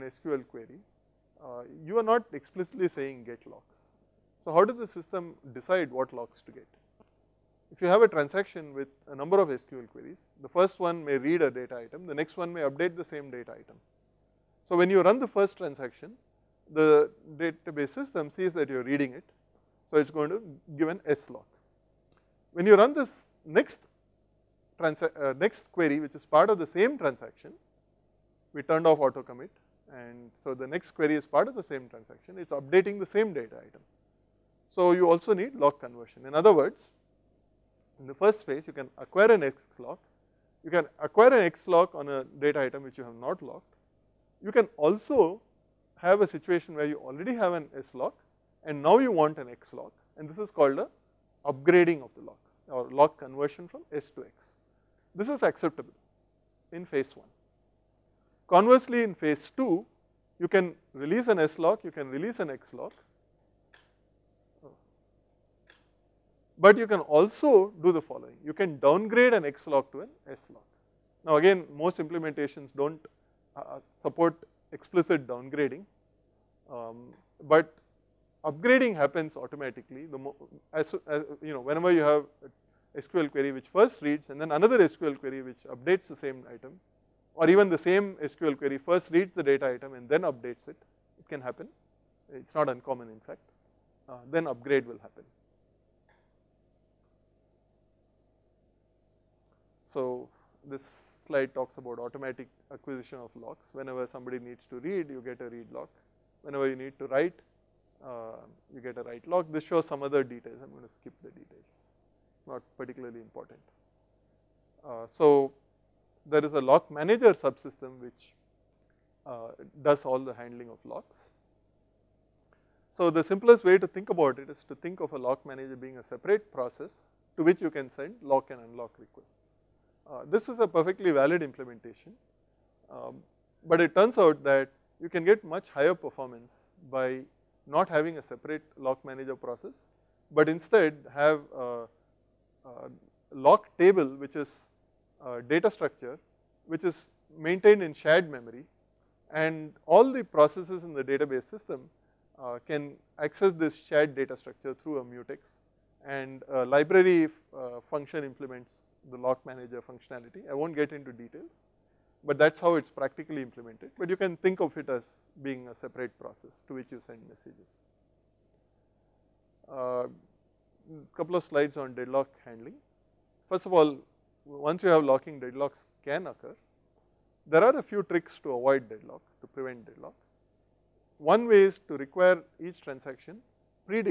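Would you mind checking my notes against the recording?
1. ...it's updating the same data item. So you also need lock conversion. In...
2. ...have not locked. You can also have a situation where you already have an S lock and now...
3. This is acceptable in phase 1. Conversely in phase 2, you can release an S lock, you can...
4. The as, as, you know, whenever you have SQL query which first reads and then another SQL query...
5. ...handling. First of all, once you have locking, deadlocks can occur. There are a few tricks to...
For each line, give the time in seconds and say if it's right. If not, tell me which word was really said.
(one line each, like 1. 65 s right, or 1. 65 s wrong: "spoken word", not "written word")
1. 32 s right
2. 43 s right
3. 55 s right
4. 80 s right
5. 172 s right.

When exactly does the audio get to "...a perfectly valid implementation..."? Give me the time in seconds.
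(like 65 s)
130 s.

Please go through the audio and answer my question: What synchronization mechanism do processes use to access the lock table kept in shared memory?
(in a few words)
mutex.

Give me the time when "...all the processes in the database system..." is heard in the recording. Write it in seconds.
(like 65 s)
149 s.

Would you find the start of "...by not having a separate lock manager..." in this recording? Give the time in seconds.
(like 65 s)
136 s.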